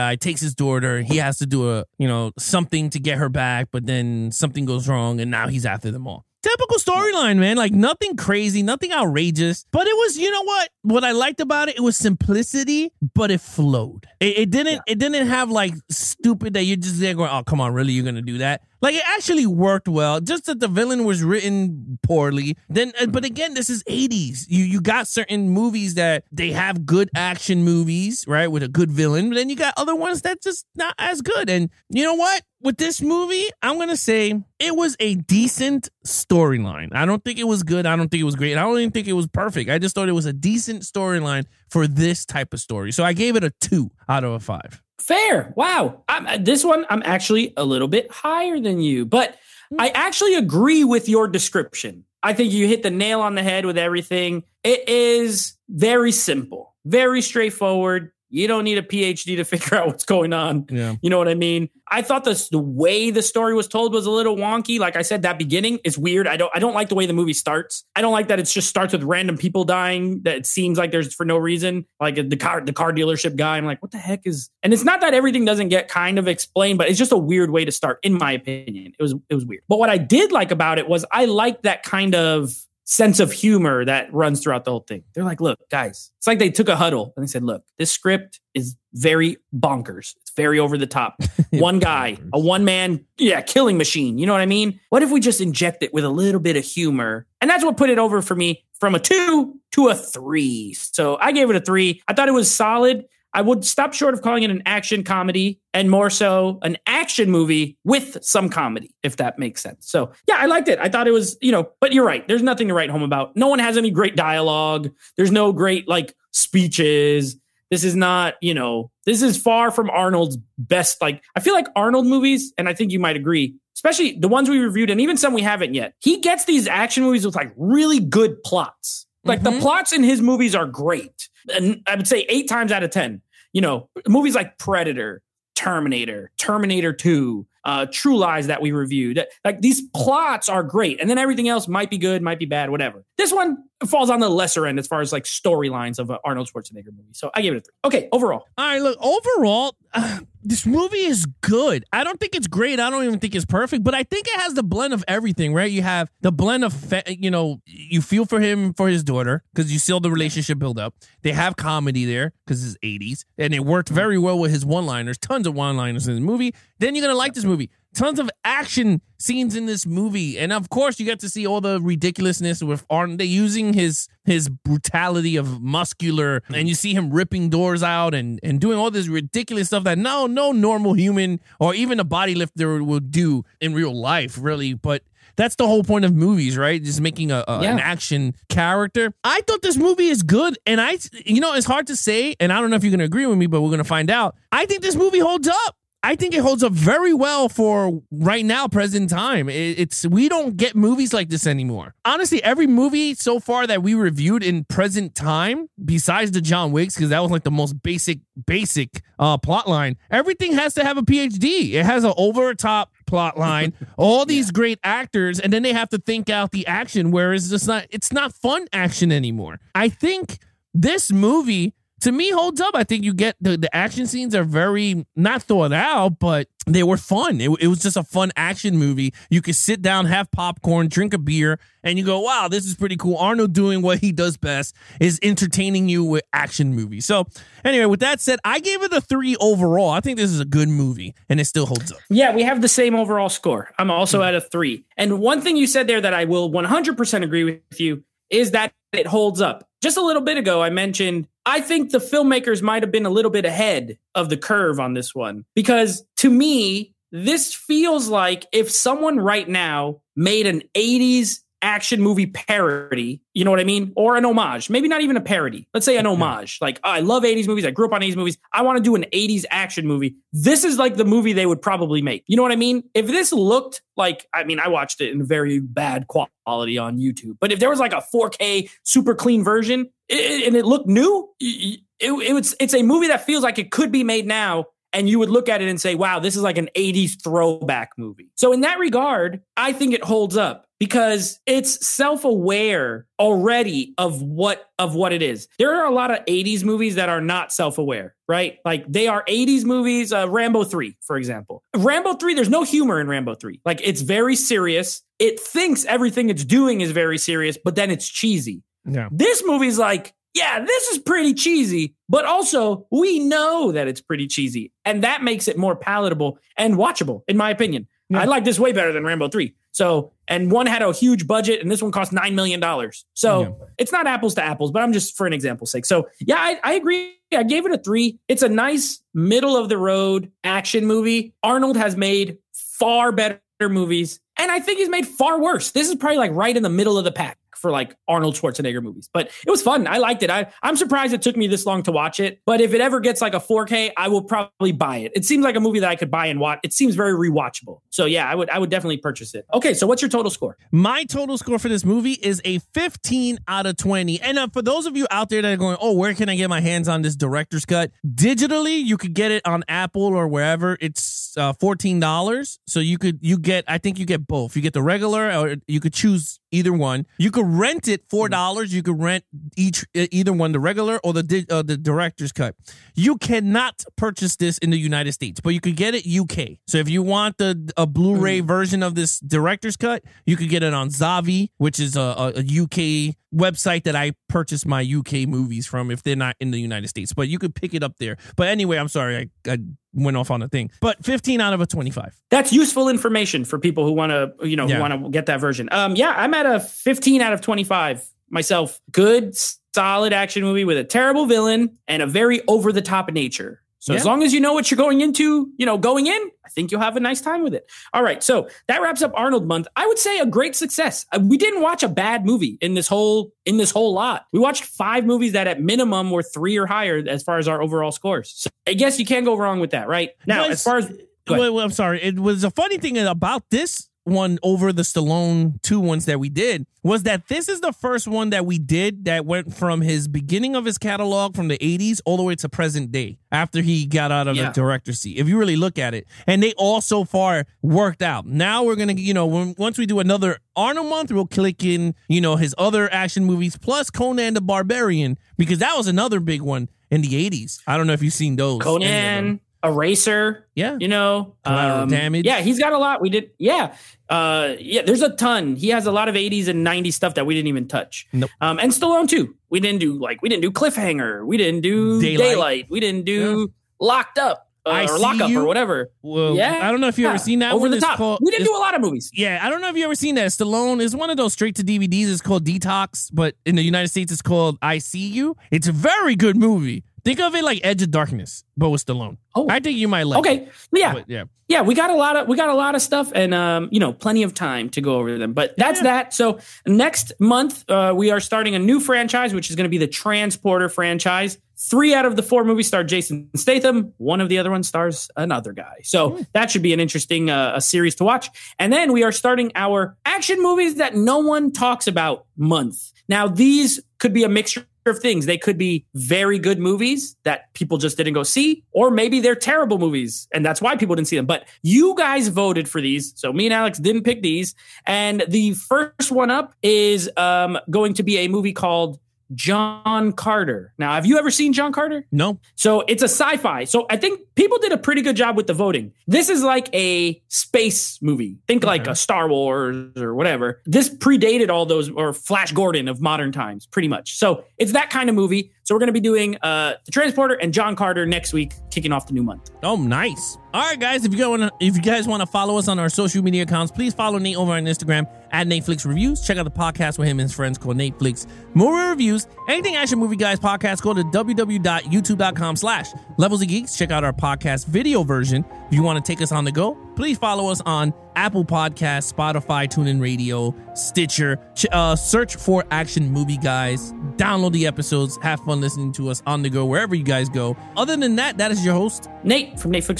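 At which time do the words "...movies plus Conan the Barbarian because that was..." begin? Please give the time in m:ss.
7:23.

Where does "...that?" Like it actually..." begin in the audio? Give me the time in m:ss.
0:18.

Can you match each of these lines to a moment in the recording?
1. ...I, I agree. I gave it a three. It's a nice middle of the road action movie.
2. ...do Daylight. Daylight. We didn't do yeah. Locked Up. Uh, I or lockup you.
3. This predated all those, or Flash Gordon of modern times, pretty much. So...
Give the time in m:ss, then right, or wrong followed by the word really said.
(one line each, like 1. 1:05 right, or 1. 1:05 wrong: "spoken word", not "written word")
1. 5:26 right
2. 7:41 right
3. 8:50 right.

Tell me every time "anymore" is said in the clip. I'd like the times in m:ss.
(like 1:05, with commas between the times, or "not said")
3:21, 3:39.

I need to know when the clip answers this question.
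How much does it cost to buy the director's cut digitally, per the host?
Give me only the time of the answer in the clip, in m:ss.
6:01.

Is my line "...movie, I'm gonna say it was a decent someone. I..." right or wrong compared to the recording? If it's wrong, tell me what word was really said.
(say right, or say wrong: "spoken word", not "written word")
wrong: "storyline", not "someone".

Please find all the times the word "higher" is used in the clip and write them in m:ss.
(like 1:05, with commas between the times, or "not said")
0:48, 6:56.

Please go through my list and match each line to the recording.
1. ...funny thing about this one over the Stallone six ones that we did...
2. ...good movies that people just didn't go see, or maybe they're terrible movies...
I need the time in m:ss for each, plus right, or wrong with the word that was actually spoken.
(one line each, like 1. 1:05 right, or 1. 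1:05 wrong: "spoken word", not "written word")
1. 7:02 wrong: "two", not "six"
2. 8:26 right.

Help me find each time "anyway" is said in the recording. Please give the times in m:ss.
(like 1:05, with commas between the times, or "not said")
3:57, 6:28.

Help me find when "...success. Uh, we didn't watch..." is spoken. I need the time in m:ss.
6:50.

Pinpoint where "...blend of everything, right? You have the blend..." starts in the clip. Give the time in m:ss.
2:34.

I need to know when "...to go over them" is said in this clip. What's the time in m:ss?
8:04.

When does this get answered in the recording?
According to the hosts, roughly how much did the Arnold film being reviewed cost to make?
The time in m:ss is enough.
5:22.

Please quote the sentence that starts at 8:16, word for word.
that should be an interesting uh, a series to watch.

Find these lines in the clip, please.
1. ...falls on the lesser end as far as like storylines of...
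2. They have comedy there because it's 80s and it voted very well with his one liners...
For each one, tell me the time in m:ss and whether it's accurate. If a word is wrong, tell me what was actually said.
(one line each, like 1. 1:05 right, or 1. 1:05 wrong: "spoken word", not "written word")
1. 2:23 right
2. 2:41 wrong: "worked", not "voted".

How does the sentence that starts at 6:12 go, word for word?
You cannot purchase this in the United States, but you could get it UK.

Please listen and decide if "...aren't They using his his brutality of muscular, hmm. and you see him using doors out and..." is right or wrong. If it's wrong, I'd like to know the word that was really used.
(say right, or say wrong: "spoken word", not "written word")
wrong: "ripping", not "using".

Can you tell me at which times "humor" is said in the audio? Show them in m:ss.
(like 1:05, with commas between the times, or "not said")
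1:23, 1:36, 5:02.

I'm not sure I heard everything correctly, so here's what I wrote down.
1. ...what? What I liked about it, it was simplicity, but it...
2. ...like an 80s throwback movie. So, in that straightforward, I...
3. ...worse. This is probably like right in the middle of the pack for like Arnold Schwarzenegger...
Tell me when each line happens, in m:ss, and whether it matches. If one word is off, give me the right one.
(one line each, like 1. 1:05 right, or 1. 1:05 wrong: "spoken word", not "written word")
1. 0:10 right
2. 4:46 wrong: "regard", not "straightforward"
3. 5:35 right.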